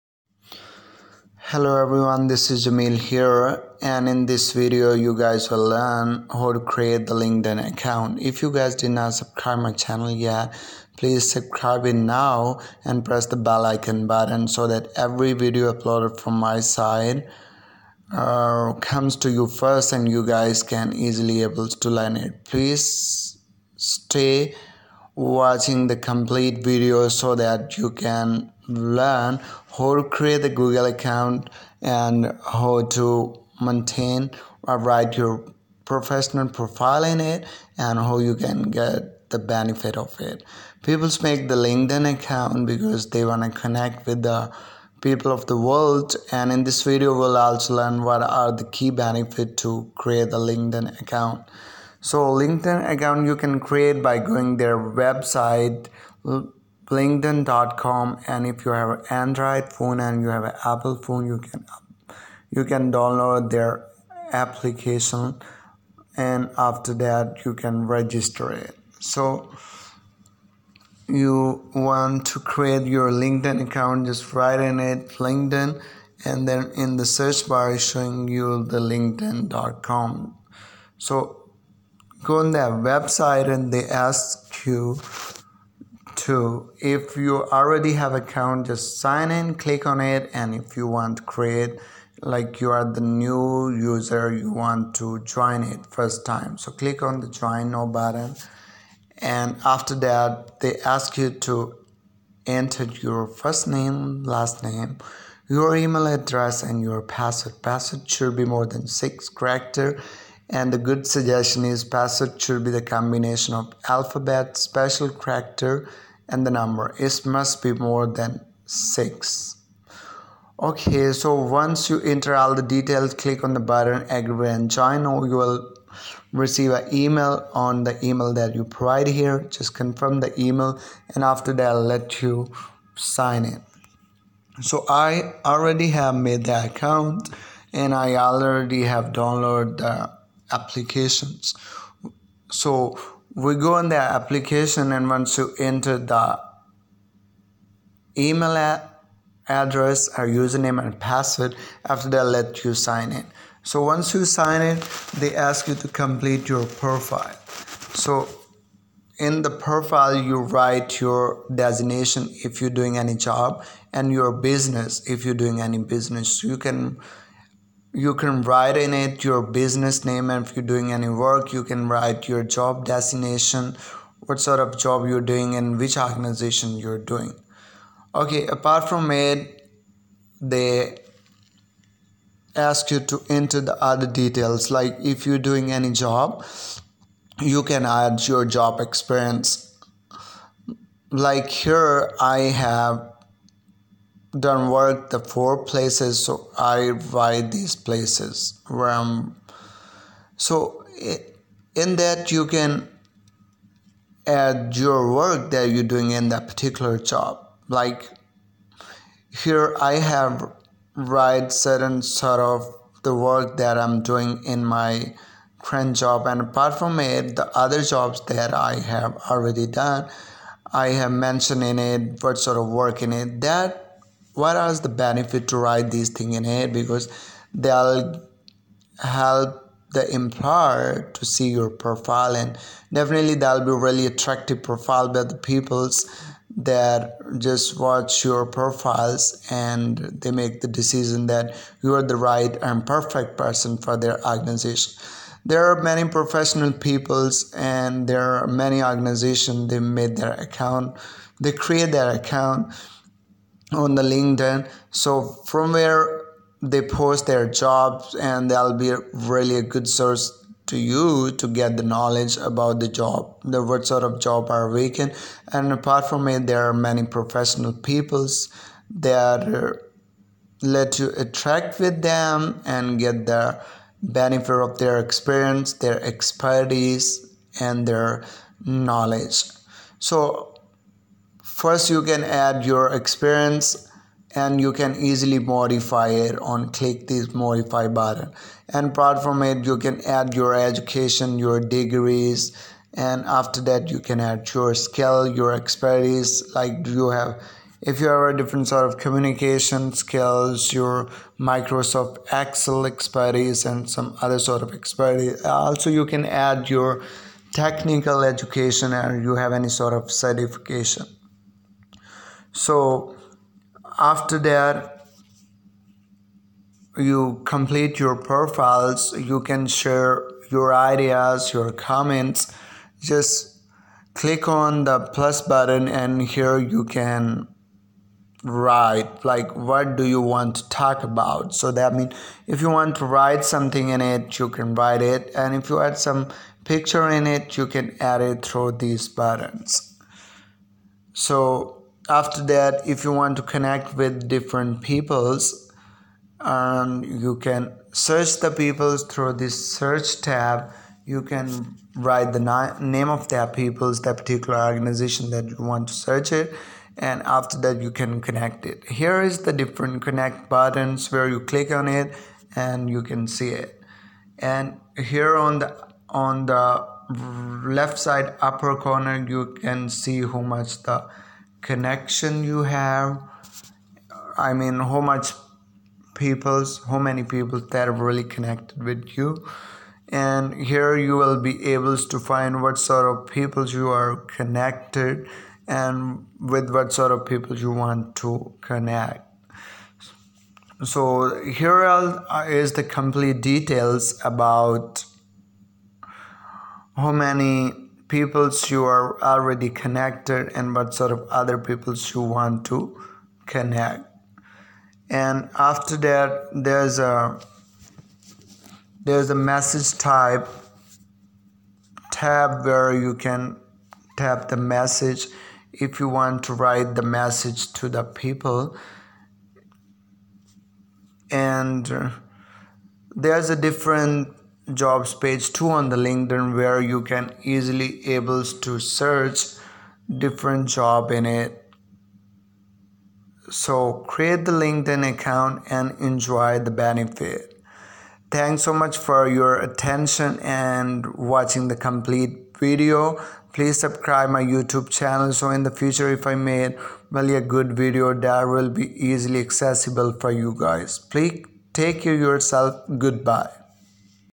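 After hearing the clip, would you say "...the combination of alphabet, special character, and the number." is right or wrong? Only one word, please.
right.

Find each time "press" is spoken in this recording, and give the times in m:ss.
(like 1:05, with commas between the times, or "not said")
0:13.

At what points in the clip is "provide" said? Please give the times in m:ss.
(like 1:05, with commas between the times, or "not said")
2:08.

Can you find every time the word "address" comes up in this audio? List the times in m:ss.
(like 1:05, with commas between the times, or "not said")
1:46, 2:29.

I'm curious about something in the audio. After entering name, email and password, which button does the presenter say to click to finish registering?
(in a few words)
agree and join.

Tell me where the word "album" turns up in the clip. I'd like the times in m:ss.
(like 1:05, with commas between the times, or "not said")
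not said.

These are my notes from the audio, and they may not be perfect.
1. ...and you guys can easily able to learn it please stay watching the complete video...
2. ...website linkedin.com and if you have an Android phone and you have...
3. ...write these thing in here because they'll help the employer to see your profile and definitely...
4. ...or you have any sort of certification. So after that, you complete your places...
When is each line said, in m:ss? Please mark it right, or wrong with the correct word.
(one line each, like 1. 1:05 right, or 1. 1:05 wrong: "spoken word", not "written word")
1. 0:19 right
2. 0:54 right
3. 3:45 right
4. 5:08 wrong: "profiles", not "places".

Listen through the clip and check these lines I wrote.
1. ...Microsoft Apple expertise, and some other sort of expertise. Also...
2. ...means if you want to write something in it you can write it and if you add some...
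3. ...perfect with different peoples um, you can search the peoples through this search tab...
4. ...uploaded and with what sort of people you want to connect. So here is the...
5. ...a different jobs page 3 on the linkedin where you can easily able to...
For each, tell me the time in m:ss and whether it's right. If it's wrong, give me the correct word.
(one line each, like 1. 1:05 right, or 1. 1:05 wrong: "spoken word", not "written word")
1. 5:01 wrong: "Excel", not "Apple"
2. 5:31 right
3. 5:43 wrong: "connect", not "perfect"
4. 6:24 wrong: "connected", not "uploaded"
5. 7:03 wrong: "2", not "3".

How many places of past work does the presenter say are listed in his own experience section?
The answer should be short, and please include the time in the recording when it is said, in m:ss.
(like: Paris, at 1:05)
4, at 3:15.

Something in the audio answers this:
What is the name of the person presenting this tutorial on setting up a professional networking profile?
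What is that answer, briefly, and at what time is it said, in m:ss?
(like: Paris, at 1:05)
Jamil, at 0:02.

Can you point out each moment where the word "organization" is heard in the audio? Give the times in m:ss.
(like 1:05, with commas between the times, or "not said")
2:55, 4:04, 4:08, 5:54.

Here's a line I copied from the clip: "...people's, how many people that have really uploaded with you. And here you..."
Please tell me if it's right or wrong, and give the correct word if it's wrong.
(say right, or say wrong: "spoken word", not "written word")
wrong: "connected", not "uploaded".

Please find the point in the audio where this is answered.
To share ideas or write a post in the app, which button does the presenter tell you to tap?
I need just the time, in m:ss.
5:24.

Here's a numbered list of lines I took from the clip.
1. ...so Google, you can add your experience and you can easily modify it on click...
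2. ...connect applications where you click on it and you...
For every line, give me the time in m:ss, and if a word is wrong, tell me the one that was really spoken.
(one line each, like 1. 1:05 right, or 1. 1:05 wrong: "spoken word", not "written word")
1. 4:39 wrong: "First", not "Google"
2. 6:00 wrong: "buttons", not "applications".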